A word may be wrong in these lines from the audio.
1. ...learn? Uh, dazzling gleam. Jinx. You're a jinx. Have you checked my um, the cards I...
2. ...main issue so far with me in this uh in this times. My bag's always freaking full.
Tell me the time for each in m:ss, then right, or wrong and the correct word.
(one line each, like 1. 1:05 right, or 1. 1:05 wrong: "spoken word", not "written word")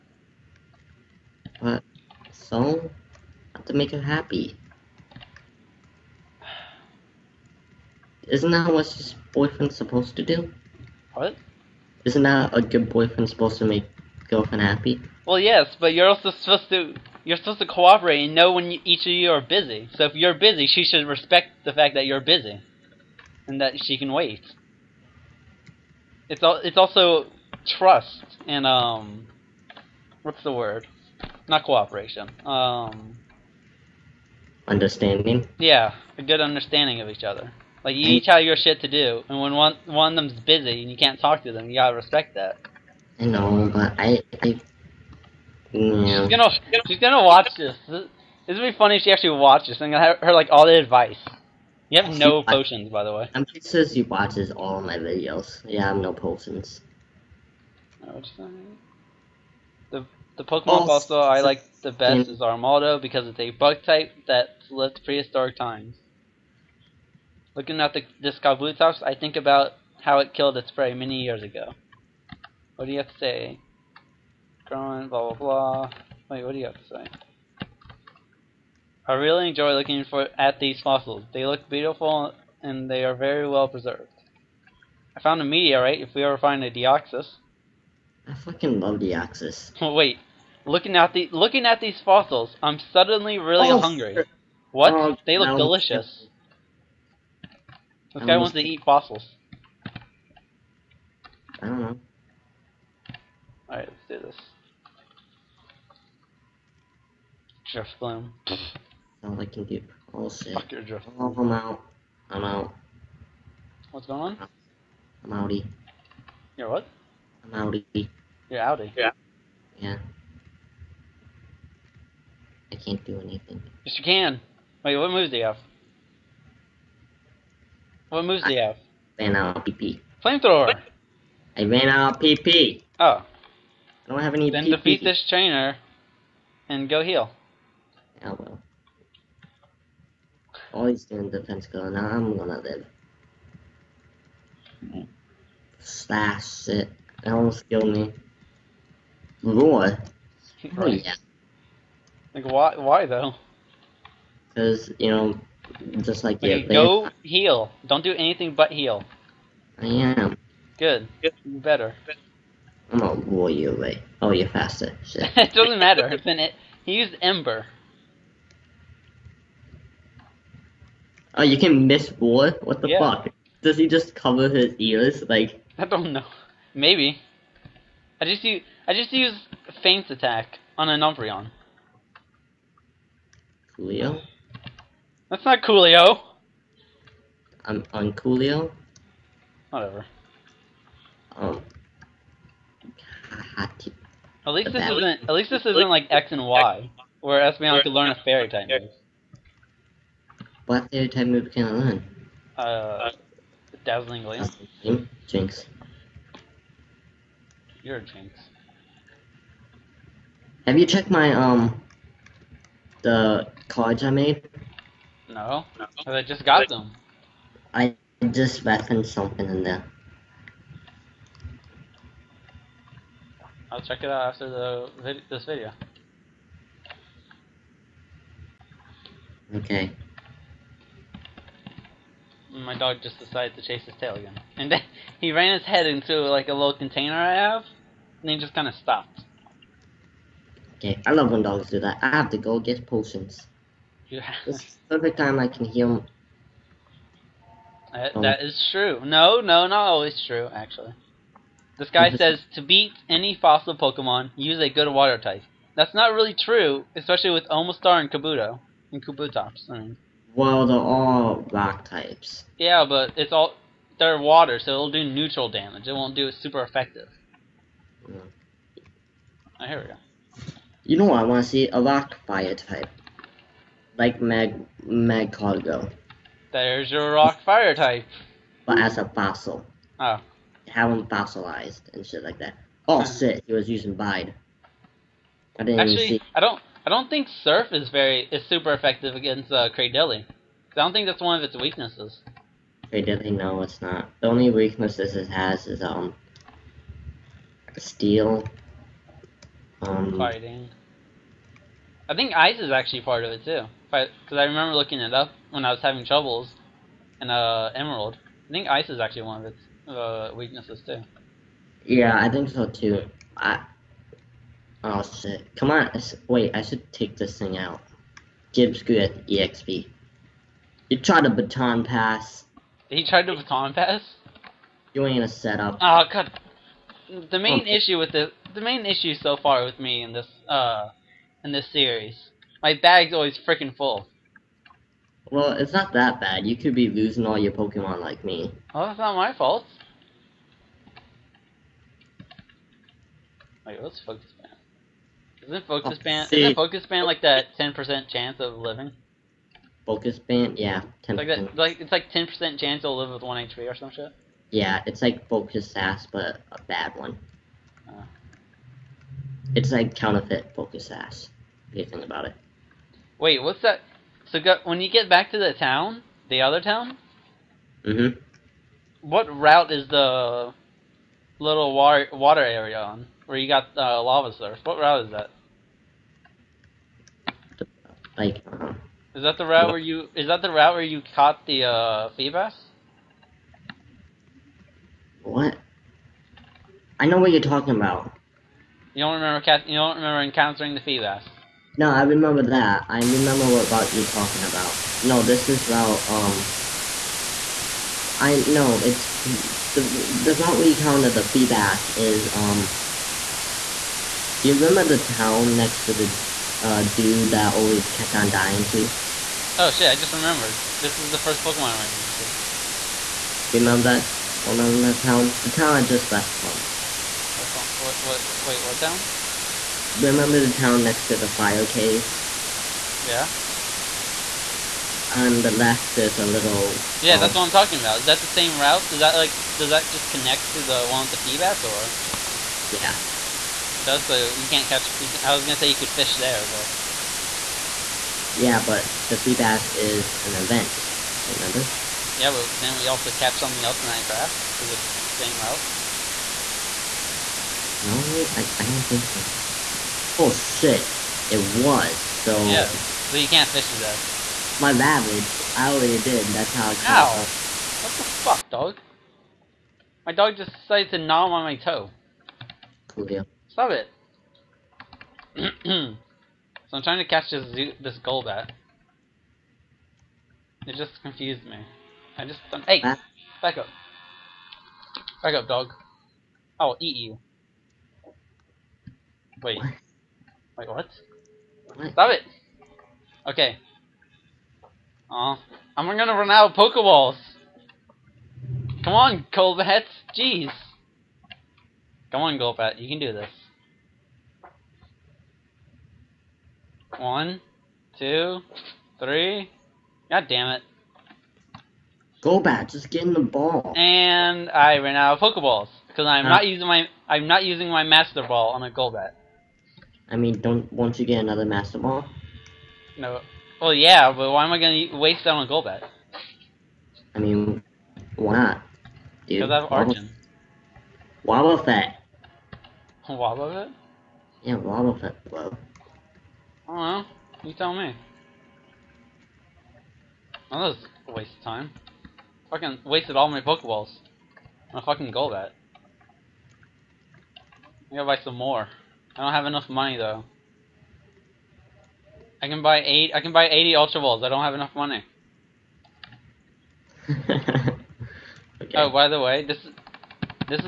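1. 3:21 right
2. 5:28 wrong: "series", not "times".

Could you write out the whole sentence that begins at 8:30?
I mean, don't won't you get another Master Ball?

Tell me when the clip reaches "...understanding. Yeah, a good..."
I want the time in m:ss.
0:34.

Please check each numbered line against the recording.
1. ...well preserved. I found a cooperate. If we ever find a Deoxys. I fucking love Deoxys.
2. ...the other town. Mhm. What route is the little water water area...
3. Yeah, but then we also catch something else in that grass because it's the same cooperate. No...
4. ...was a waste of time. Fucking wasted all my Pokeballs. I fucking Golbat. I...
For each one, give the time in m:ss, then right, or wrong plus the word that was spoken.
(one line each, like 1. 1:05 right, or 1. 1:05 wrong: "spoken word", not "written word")
1. 1:23 wrong: "meteorite", not "cooperate"
2. 6:06 right
3. 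7:22 wrong: "route", not "cooperate"
4. 8:50 right.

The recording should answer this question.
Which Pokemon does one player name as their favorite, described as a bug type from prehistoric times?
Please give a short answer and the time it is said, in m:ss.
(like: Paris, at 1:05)
Armaldo, at 1:02.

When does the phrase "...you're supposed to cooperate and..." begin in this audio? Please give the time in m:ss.
0:17.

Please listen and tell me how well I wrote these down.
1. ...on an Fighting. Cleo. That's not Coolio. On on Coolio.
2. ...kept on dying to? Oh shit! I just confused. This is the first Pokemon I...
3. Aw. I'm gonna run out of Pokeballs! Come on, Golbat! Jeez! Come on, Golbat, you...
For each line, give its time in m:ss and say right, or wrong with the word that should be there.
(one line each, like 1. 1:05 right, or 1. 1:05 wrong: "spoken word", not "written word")
1. 3:00 wrong: "Umbreon", not "Fighting"
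2. 6:47 wrong: "remembered", not "confused"
3. 8:05 right.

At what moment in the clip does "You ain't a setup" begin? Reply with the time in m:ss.
5:24.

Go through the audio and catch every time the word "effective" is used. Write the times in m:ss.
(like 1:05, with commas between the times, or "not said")
4:26, 4:48.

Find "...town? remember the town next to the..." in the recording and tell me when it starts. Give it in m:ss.
6:58.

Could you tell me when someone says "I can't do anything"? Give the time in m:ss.
2:02.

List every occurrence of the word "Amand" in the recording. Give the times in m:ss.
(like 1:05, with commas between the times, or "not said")
not said.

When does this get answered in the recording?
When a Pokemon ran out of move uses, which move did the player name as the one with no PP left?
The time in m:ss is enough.
2:10.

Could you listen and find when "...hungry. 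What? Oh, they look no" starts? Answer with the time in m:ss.
1:33.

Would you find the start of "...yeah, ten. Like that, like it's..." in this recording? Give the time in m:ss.
5:50.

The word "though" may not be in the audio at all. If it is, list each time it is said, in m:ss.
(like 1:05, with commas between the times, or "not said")
2:33, 8:59.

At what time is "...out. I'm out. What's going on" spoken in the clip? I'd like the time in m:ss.
1:51.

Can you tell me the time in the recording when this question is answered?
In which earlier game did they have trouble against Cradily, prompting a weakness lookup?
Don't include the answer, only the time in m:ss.
5:07.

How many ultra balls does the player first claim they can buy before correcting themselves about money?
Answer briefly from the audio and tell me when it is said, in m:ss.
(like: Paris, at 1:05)
80, at 9:03.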